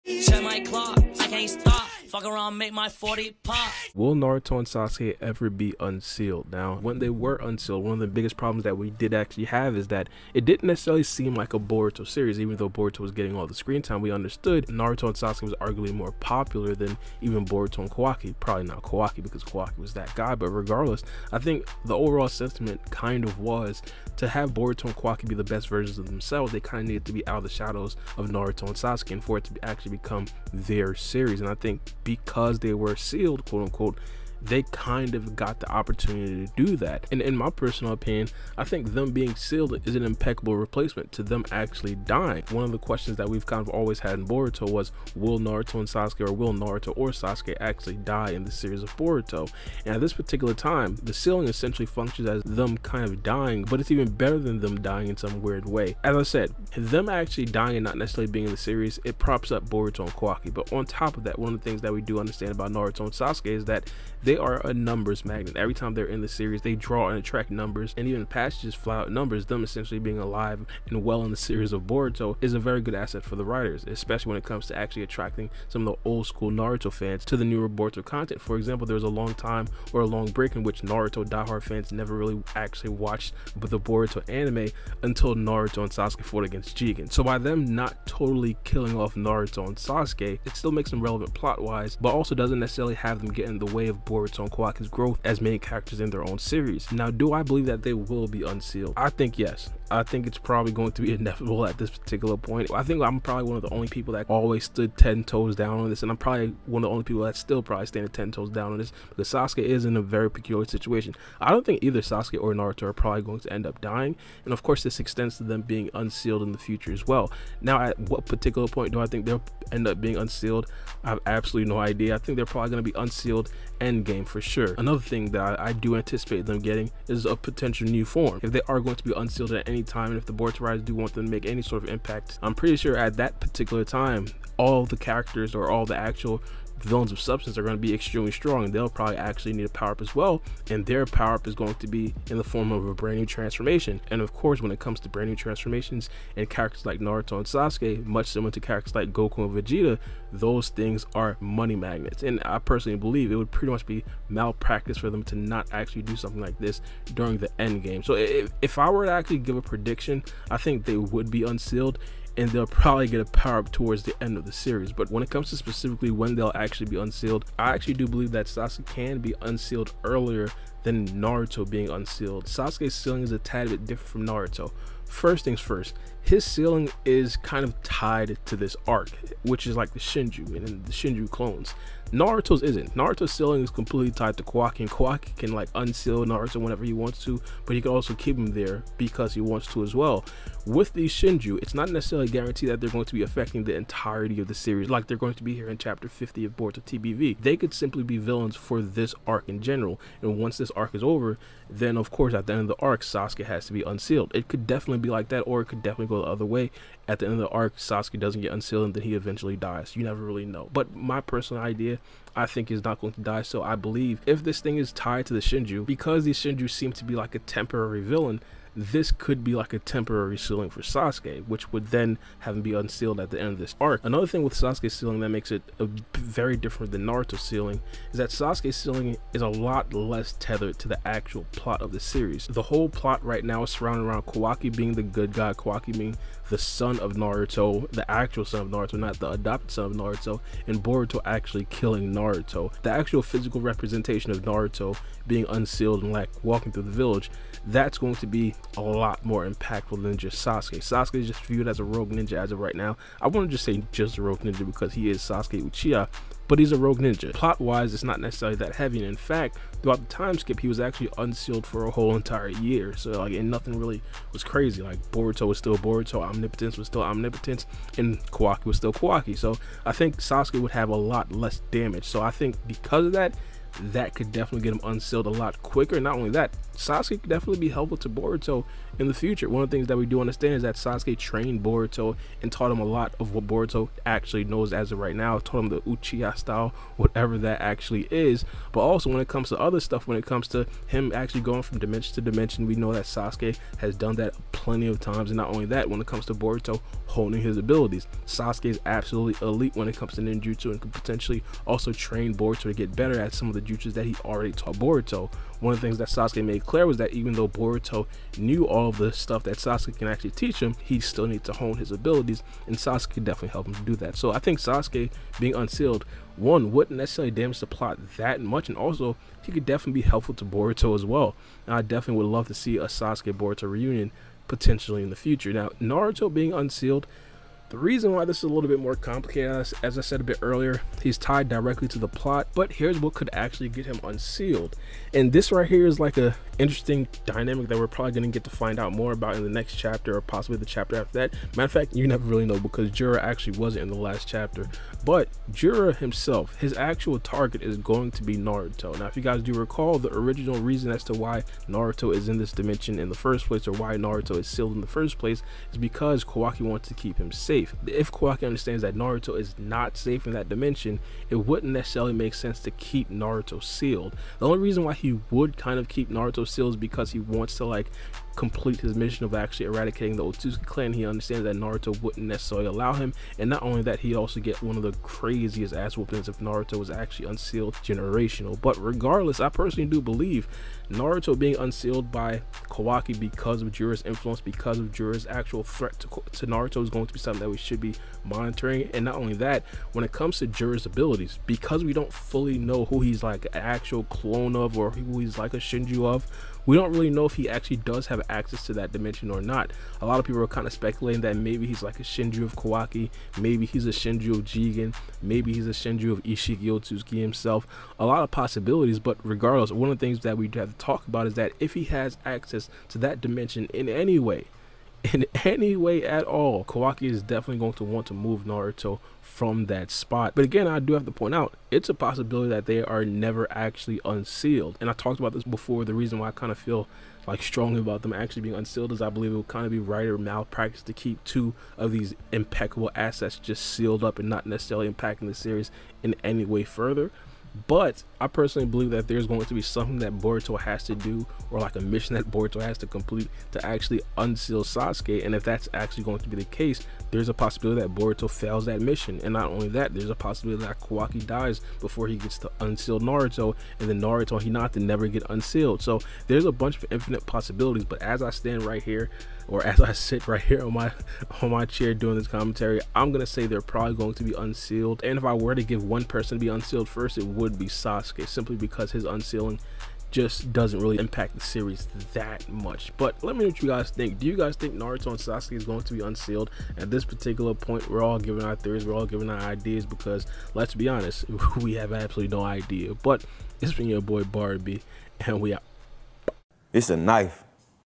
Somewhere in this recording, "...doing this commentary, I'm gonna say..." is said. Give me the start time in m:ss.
7:41.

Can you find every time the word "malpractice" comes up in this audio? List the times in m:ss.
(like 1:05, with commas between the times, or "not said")
2:34, 7:10.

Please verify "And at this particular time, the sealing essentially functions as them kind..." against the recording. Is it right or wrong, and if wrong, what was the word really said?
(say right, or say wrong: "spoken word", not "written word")
right.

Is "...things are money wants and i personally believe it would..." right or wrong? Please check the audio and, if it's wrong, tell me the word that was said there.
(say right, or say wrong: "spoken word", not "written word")
wrong: "magnets", not "wants".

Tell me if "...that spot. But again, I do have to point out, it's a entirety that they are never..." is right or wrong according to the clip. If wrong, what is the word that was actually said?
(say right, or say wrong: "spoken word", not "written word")
wrong: "possibility", not "entirety".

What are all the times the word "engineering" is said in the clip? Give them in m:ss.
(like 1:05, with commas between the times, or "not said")
not said.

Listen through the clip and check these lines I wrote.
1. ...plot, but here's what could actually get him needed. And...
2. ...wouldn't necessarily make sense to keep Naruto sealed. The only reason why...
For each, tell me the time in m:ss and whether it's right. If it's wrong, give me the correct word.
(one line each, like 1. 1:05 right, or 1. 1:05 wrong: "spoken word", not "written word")
1. 5:32 wrong: "unsealed", not "needed"
2. 6:01 right.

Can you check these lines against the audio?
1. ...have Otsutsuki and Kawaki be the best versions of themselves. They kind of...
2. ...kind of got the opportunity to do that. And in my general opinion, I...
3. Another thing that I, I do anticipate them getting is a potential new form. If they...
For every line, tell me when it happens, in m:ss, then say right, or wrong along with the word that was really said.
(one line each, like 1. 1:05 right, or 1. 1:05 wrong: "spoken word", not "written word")
1. 0:24 wrong: "Boruto", not "Otsutsuki"
2. 0:34 wrong: "personal", not "general"
3. 2:04 right.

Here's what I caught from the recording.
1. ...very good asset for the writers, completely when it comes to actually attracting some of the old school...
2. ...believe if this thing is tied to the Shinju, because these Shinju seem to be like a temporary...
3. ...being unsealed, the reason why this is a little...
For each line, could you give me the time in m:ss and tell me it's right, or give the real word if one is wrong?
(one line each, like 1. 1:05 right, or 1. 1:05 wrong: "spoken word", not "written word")
1. 1:12 wrong: "especially", not "completely"
2. 3:33 right
3. 5:26 right.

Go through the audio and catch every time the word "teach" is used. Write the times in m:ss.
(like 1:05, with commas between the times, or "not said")
5:10.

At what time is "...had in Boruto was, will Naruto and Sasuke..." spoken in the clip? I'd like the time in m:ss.
0:43.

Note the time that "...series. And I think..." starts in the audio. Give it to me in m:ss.
0:30.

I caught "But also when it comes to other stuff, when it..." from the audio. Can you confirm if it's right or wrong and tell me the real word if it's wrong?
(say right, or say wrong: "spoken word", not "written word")
right.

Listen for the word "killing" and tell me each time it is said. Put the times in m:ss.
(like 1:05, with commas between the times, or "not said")
1:28, 4:01.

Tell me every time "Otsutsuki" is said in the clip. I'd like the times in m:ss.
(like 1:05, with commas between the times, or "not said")
6:10, 6:46.